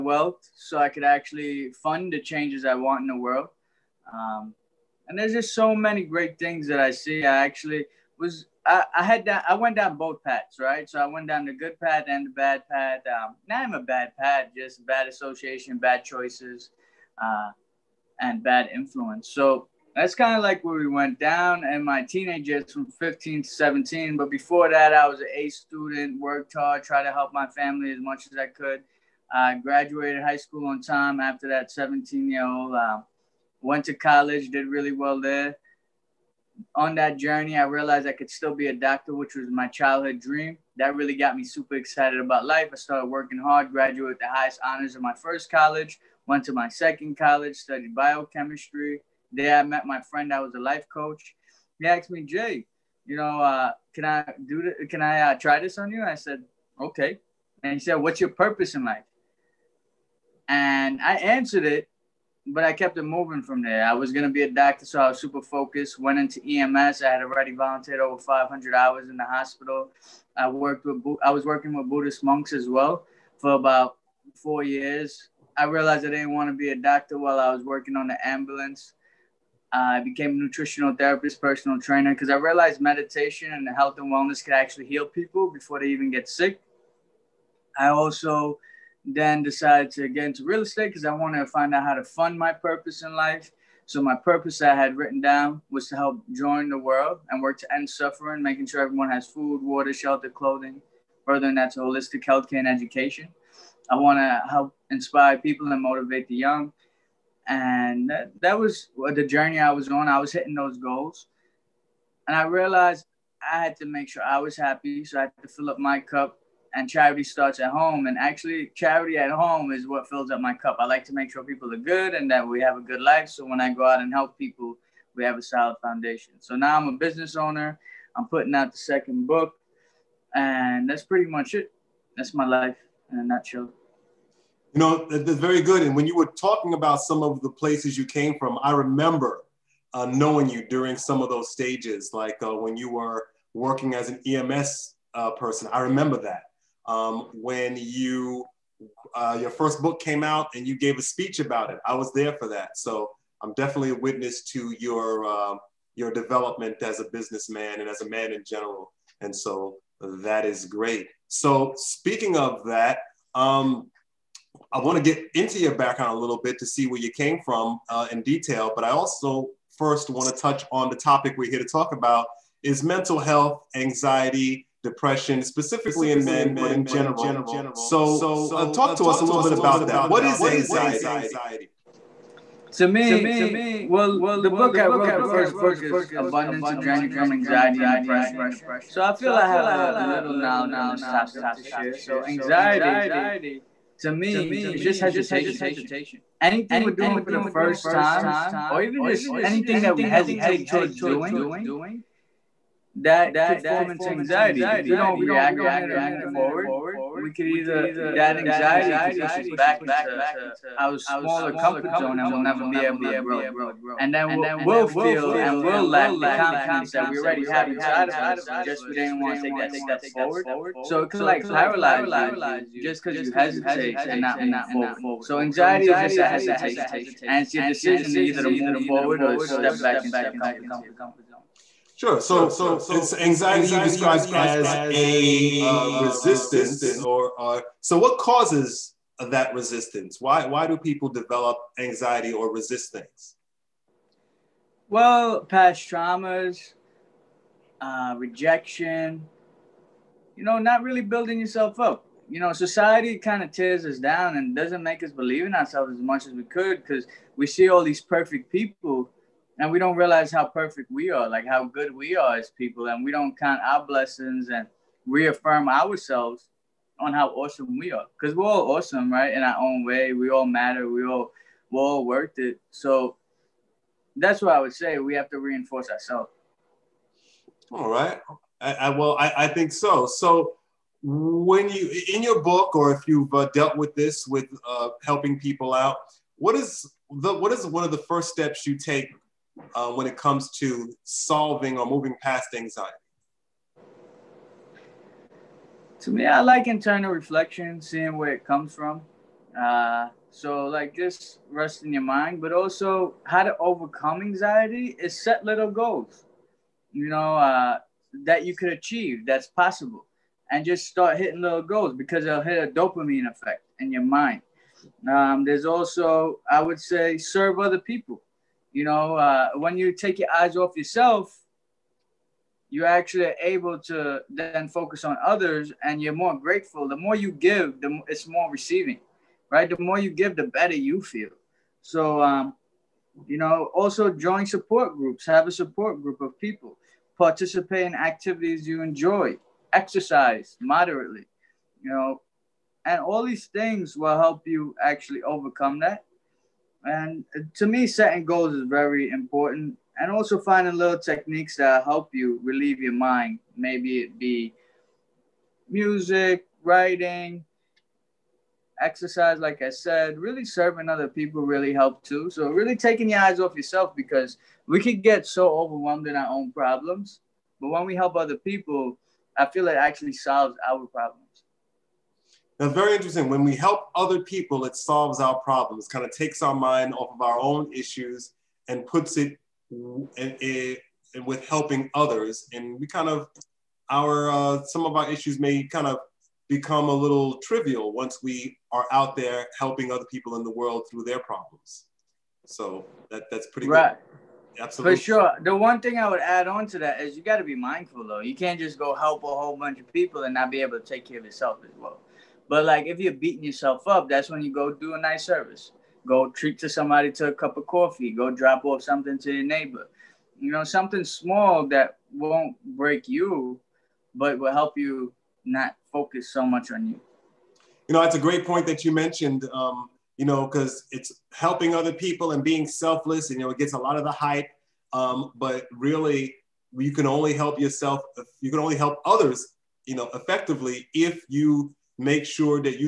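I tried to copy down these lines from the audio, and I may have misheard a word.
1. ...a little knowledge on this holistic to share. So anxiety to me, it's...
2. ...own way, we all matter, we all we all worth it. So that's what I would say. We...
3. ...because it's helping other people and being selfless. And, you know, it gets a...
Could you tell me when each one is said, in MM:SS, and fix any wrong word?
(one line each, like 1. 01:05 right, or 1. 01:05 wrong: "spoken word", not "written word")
1. 03:09 wrong: "topic", not "holistic"
2. 04:29 right
3. 07:00 right.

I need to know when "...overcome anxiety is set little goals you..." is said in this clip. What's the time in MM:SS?
05:03.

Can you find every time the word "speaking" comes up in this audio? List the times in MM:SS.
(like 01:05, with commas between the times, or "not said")
02:41.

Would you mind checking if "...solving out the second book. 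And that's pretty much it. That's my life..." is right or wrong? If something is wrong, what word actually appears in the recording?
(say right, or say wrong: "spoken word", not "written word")
wrong: "putting", not "solving".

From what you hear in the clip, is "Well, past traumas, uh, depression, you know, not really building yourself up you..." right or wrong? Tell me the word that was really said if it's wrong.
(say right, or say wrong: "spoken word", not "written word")
wrong: "rejection", not "depression".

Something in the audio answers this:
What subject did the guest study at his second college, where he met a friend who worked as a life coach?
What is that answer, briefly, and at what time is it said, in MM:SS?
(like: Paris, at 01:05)
Biochemistry, at 00:47.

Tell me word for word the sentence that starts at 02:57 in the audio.
So, uh, talk to us a little bit about that.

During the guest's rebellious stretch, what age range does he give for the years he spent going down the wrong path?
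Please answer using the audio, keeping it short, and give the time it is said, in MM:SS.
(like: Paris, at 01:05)
15 to 17, at 00:22.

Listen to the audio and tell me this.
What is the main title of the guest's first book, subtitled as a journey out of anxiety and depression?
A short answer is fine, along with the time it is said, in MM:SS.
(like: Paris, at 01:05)
Abundance, at 03:06.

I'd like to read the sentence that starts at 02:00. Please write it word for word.
I like to make sure people are good and that we have a good life.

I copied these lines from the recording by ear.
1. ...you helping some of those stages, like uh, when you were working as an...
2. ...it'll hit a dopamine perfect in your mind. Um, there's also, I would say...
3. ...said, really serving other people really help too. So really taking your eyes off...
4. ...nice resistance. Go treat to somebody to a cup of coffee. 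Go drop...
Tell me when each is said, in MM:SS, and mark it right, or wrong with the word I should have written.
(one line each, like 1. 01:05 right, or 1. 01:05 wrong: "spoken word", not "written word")
1. 02:20 wrong: "during", not "helping"
2. 05:12 wrong: "effect", not "perfect"
3. 05:59 right
4. 06:45 wrong: "service", not "resistance".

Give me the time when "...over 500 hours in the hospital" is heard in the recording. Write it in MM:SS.
01:07.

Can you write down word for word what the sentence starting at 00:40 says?
That really got me super excited about life.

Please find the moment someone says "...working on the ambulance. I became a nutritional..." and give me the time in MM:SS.
01:17.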